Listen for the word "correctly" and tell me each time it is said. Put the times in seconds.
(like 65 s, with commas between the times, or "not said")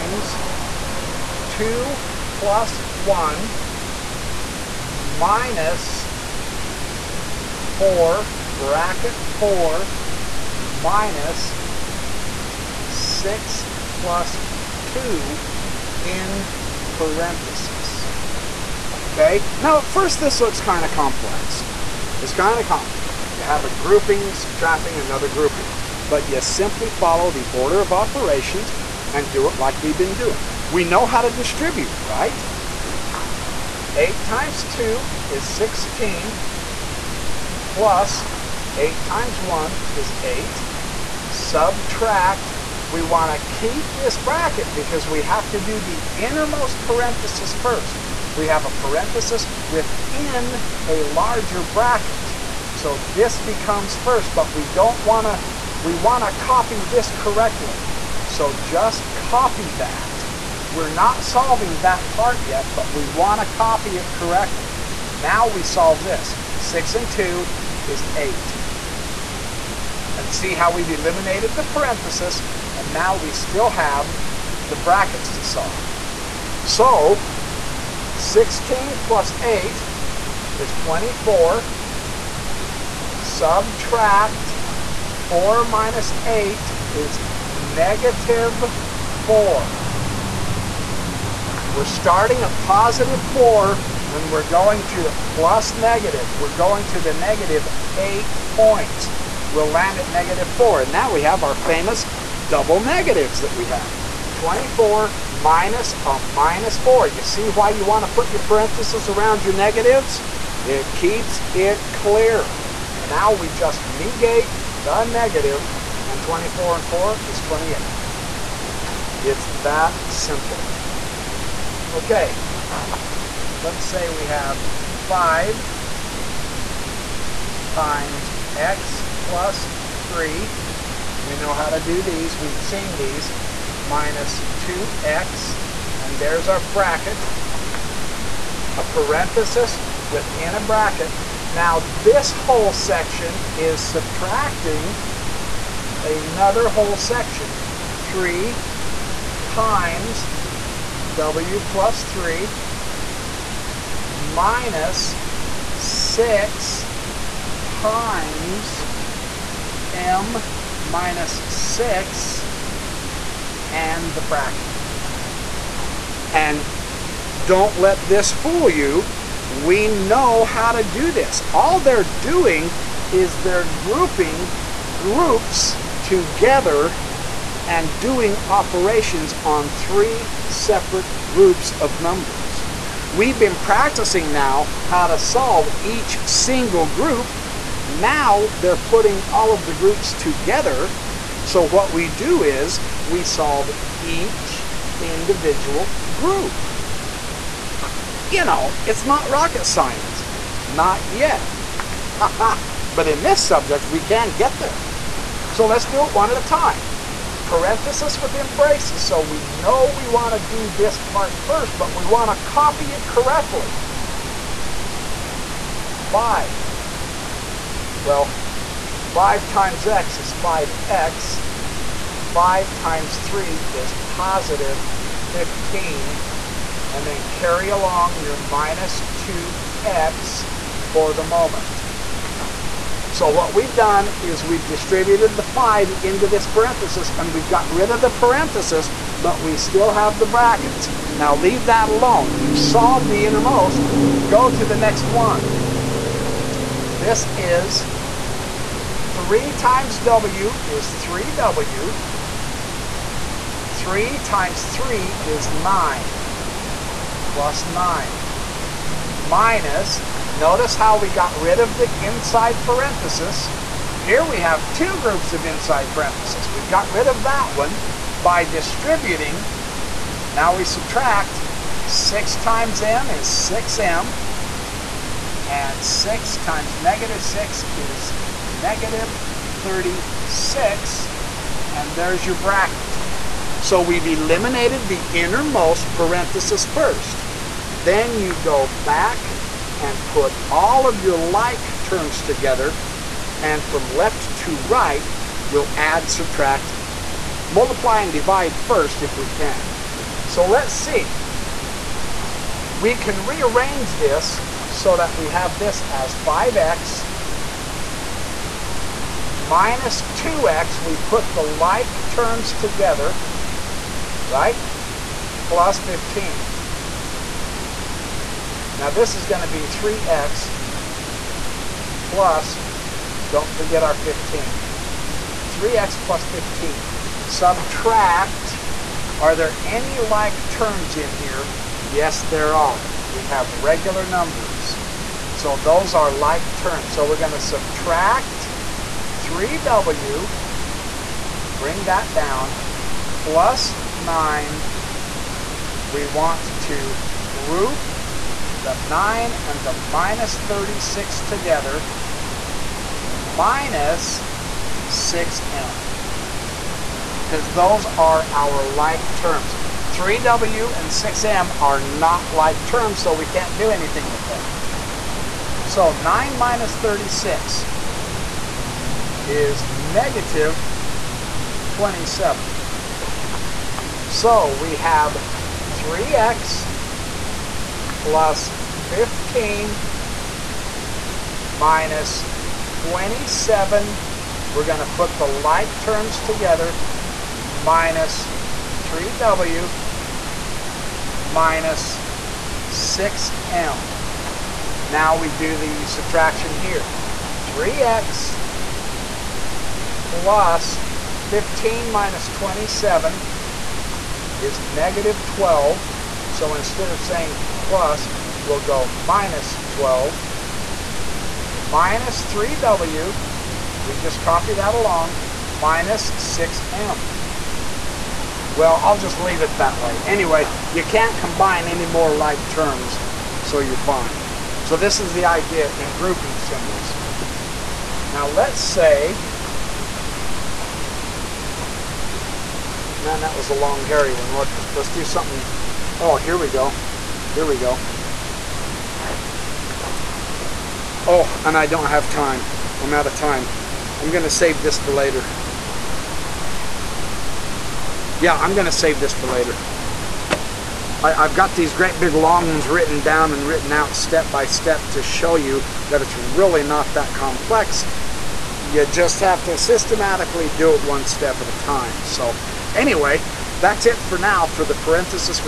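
57 s, 64 s, 213 s.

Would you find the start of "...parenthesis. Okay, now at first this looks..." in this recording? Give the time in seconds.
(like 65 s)
16 s.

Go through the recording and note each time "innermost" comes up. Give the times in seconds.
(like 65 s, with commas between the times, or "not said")
46 s, 243 s, 285 s.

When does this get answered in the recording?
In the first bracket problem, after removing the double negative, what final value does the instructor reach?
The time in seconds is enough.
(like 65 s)
116 s.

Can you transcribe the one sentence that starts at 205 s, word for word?
So let's do it one at a time.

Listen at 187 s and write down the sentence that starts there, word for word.
Now they're putting all of the groups together.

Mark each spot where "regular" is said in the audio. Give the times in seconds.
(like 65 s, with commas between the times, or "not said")
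333 s.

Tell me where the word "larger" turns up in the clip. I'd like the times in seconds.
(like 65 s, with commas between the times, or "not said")
51 s.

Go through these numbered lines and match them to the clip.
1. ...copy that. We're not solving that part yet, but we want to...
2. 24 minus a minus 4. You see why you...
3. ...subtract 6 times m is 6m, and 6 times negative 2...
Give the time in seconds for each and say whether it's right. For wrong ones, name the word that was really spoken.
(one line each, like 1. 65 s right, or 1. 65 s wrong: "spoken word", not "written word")
1. 59 s right
2. 104 s right
3. 270 s wrong: "6", not "2".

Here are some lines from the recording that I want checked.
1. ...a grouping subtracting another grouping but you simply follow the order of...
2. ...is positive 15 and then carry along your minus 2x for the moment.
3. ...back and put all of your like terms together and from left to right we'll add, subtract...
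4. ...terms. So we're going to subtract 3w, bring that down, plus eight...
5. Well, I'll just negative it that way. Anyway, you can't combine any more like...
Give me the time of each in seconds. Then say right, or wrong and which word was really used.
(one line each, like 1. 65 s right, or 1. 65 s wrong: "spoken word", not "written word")
1. 23 s right
2. 223 s right
3. 288 s right
4. 336 s wrong: "nine", not "eight"
5. 418 s wrong: "leave", not "negative".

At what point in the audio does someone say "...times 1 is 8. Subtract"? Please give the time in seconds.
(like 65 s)
39 s.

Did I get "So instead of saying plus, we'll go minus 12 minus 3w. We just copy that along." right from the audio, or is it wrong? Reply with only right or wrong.
right.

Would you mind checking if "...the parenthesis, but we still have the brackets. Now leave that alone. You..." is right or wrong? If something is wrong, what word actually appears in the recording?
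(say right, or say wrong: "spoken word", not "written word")
right.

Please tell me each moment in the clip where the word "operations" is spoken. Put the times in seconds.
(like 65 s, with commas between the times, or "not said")
27 s, 178 s.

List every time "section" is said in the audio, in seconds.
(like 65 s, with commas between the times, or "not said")
142 s, 146 s.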